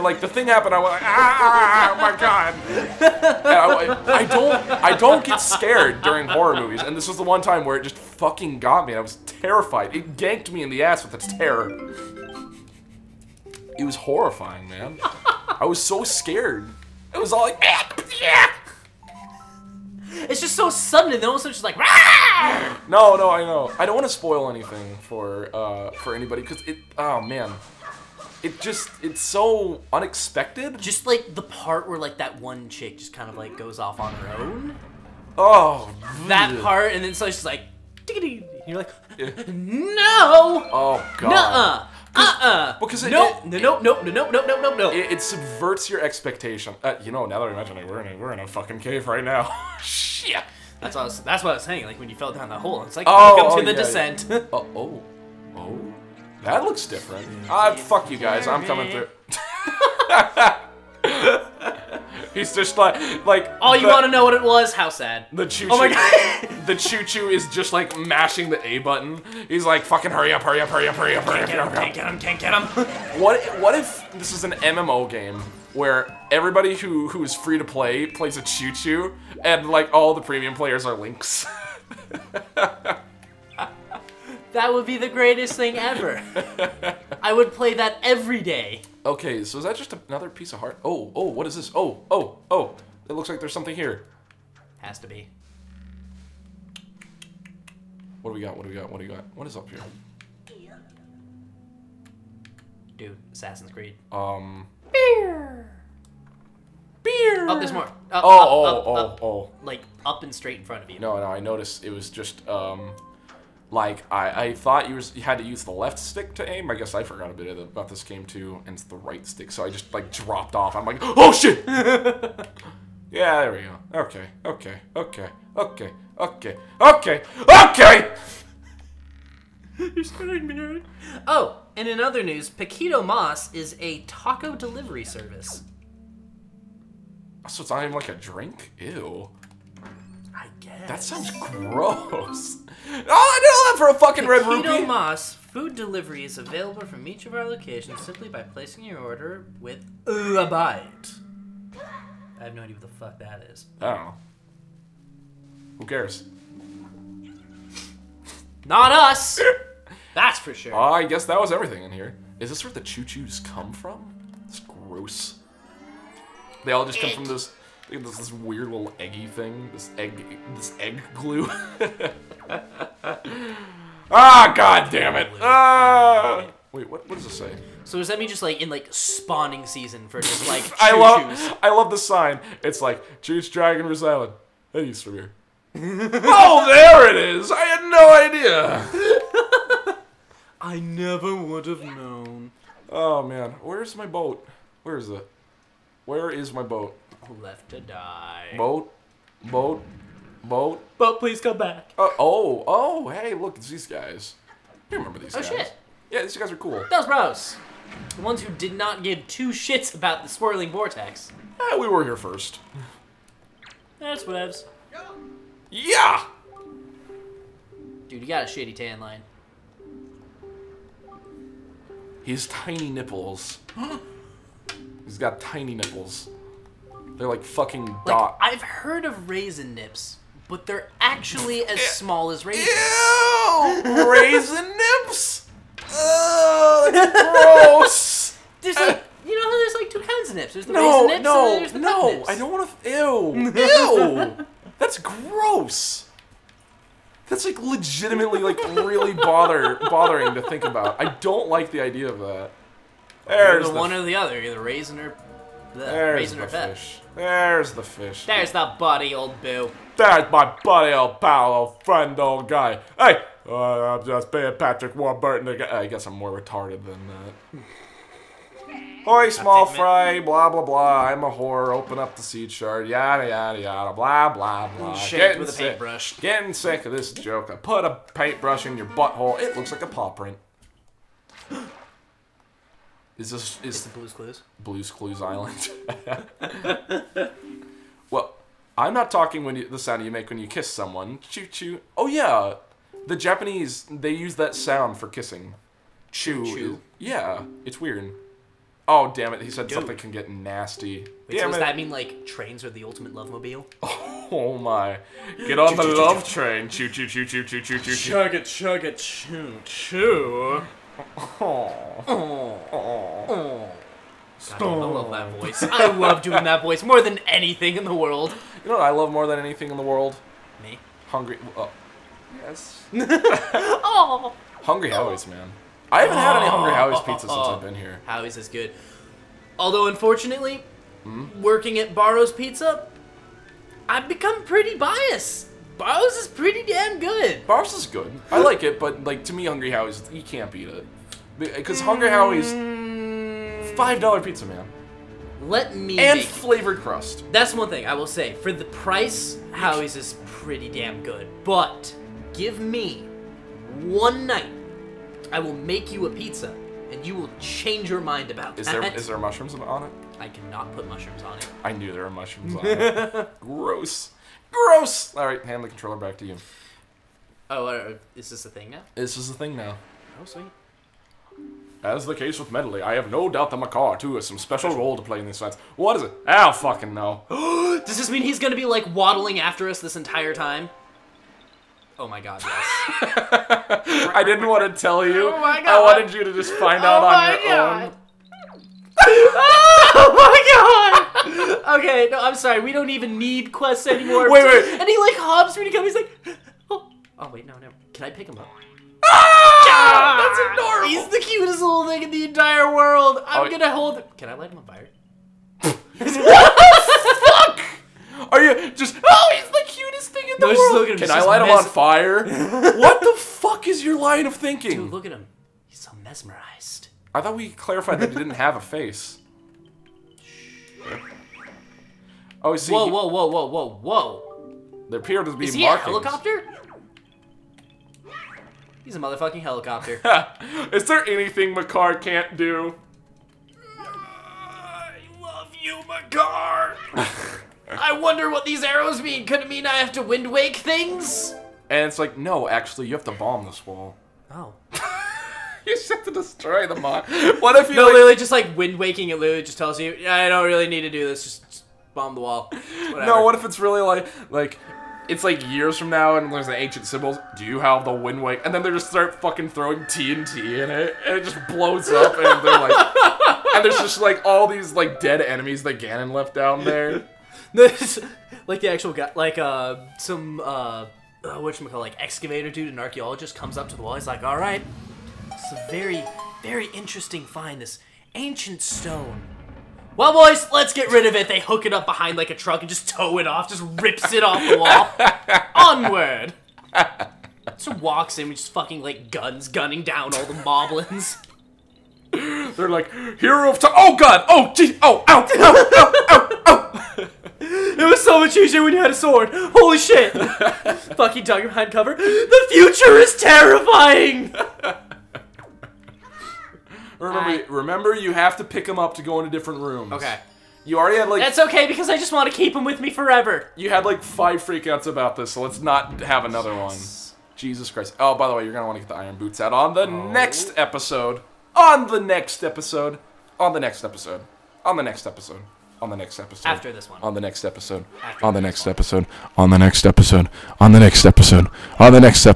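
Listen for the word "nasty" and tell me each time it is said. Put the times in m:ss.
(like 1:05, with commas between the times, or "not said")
5:00.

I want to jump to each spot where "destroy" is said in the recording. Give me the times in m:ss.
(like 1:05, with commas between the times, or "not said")
7:26.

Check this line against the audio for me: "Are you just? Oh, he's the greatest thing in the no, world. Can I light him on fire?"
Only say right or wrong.
wrong.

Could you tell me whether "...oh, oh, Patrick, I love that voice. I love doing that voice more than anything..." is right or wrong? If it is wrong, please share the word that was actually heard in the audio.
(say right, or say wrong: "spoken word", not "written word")
wrong: "God", not "Patrick".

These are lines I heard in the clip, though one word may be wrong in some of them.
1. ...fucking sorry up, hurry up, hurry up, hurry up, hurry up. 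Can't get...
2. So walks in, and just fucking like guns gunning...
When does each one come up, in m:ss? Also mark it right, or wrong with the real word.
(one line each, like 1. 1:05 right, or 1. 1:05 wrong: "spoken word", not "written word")
1. 1:09 wrong: "hurry", not "sorry"
2. 8:07 right.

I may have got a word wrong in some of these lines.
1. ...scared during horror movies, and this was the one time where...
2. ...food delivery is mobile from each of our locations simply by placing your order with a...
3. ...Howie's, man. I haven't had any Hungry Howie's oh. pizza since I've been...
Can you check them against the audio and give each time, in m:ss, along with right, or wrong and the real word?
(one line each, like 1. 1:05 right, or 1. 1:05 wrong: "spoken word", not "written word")
1. 0:05 right
2. 2:25 wrong: "available", not "mobile"
3. 5:24 right.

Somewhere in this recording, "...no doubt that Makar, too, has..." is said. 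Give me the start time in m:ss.
6:13.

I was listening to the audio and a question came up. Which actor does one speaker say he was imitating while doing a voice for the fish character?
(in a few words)
Patrick Warburton.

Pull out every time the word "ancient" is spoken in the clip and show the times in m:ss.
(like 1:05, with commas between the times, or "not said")
7:36, 7:58.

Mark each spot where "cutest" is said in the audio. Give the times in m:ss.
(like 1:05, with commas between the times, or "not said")
6:41, 6:49.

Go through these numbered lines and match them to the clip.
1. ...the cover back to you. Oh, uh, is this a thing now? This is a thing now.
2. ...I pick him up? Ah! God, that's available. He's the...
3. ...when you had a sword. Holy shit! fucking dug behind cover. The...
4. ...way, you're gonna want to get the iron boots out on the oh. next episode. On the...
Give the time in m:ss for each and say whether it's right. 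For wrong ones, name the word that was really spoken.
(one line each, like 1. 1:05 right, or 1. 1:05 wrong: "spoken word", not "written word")
1. 6:05 wrong: "controller", not "cover"
2. 6:38 wrong: "adorable", not "available"
3. 8:18 right
4. 8:38 right.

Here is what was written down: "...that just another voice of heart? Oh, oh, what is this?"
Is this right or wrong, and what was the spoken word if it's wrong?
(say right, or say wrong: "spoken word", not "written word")
wrong: "piece", not "voice".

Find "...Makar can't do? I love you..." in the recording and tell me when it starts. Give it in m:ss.
7:11.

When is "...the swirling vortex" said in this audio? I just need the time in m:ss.
3:30.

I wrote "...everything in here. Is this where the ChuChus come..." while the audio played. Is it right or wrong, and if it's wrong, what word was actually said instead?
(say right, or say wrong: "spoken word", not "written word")
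right.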